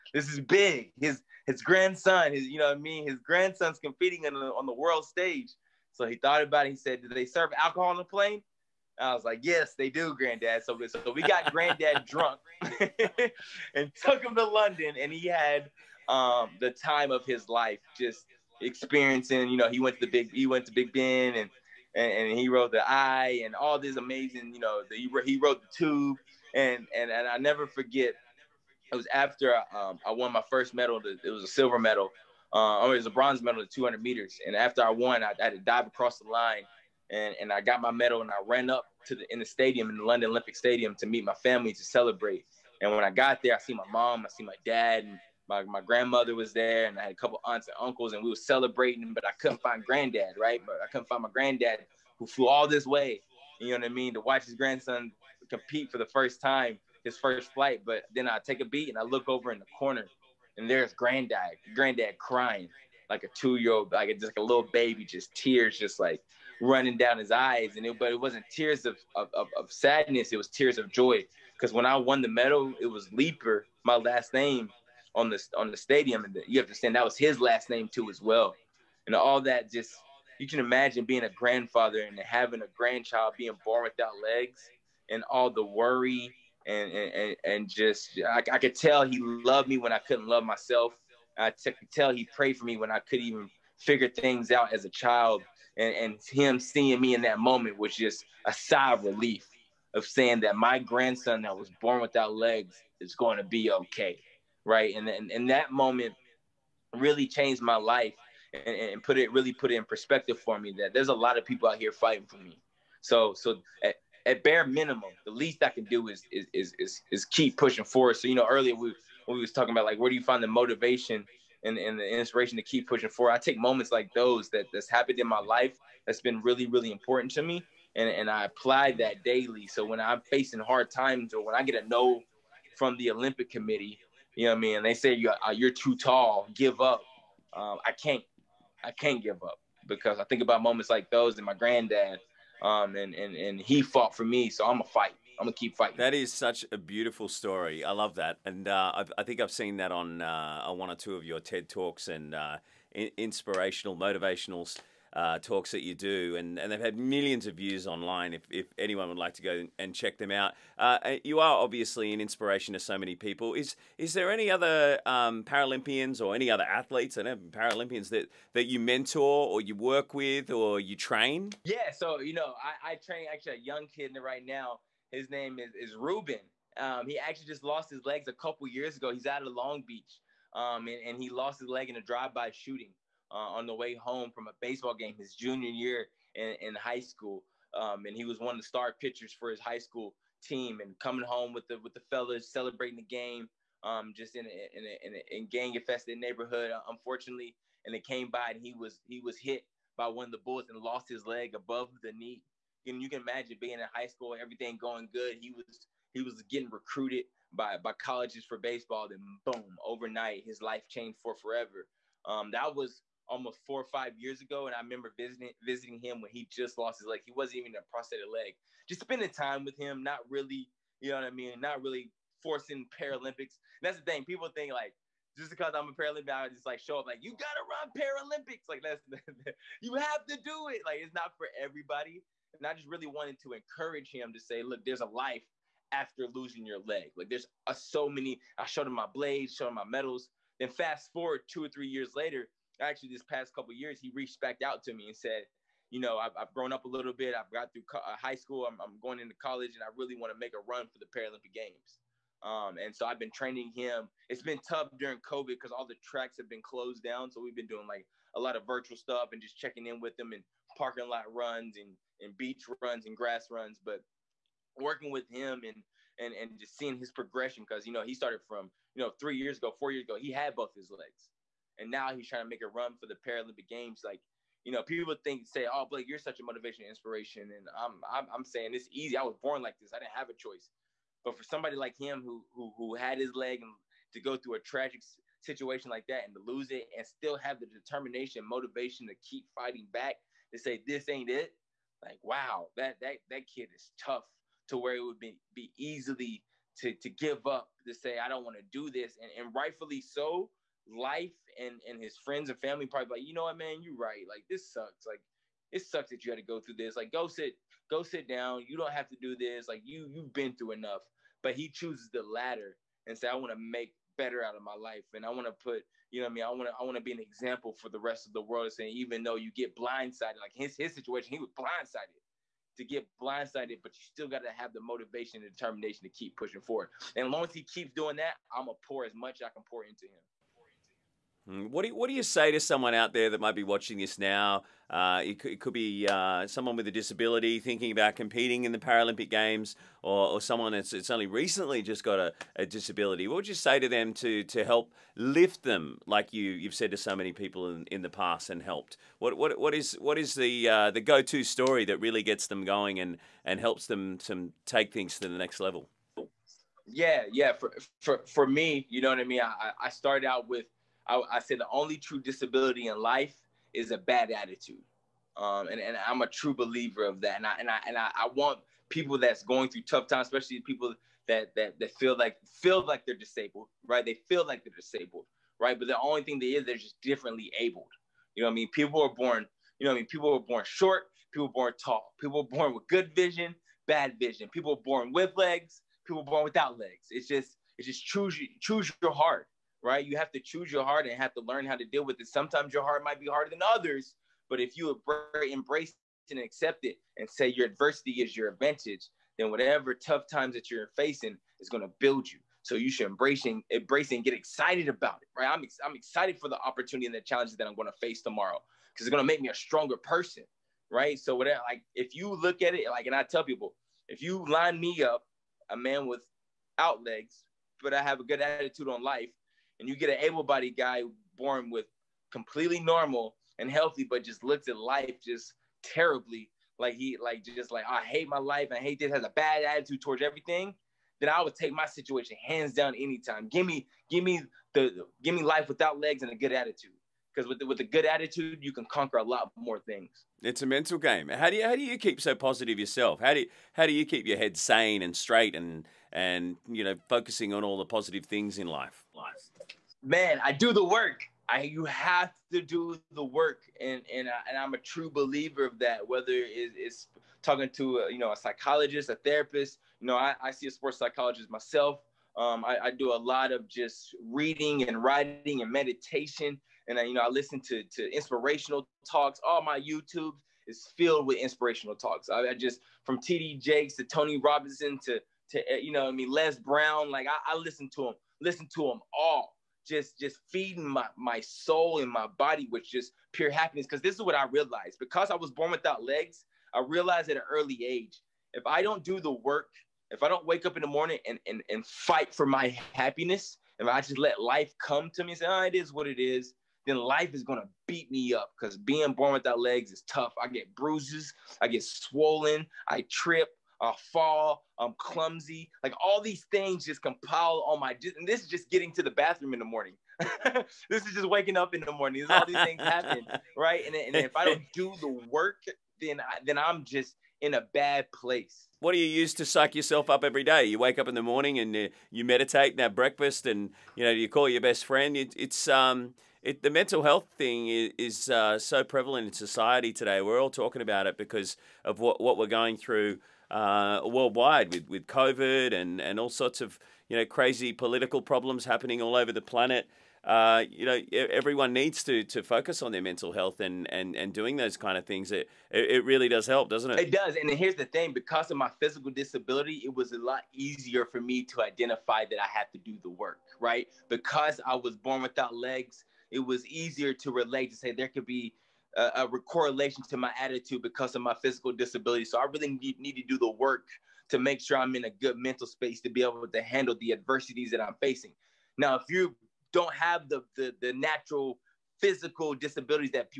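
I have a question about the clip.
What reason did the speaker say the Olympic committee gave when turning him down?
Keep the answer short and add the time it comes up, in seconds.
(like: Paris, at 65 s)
too tall, at 135 s.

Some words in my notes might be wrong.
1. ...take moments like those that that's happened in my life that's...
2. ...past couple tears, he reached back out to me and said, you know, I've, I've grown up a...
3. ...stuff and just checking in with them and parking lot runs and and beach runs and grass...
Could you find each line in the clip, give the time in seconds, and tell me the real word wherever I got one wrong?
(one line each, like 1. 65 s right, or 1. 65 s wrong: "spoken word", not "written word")
1. 123 s right
2. 243 s wrong: "years", not "tears"
3. 258 s right.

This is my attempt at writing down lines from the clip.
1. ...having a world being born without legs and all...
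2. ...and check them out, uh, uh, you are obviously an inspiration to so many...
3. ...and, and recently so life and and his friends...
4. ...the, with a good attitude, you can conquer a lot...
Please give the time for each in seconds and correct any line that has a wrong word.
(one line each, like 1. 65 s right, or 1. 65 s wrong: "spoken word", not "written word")
1. 82 s wrong: "grandchild", not "world"
2. 159 s right
3. 299 s wrong: "rightfully", not "recently"
4. 437 s right.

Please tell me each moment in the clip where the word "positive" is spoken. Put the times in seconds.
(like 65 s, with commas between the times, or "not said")
442 s, 447 s.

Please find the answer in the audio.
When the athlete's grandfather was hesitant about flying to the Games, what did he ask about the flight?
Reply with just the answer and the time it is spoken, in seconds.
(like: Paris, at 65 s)
Do they serve alcohol on the plane?, at 7 s.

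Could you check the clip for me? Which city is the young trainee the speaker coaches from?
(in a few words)
Long Beach.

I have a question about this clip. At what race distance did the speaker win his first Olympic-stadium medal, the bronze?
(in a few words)
200 meters.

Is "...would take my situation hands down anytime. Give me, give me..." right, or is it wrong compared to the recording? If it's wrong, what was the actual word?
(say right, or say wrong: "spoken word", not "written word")
right.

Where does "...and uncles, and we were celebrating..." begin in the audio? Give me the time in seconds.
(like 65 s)
47 s.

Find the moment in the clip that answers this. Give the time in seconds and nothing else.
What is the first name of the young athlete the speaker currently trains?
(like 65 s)
175 s.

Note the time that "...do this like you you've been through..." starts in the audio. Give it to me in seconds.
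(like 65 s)
309 s.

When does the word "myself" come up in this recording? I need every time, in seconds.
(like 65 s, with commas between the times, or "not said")
90 s, 461 s.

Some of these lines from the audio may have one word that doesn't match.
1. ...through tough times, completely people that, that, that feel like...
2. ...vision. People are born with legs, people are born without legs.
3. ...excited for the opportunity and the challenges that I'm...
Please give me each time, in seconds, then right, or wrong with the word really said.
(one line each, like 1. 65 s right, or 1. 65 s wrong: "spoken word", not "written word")
1. 369 s wrong: "especially", not "completely"
2. 384 s right
3. 405 s right.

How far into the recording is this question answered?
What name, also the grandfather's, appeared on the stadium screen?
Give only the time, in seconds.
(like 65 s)
73 s.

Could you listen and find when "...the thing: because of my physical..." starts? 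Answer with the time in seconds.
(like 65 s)
547 s.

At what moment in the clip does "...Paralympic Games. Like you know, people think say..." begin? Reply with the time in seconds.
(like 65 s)
273 s.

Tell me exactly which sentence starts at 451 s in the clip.
I, you have to do the work, and and I, and I'm a true believer of that.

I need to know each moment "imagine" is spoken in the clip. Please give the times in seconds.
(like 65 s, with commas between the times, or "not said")
80 s, 203 s.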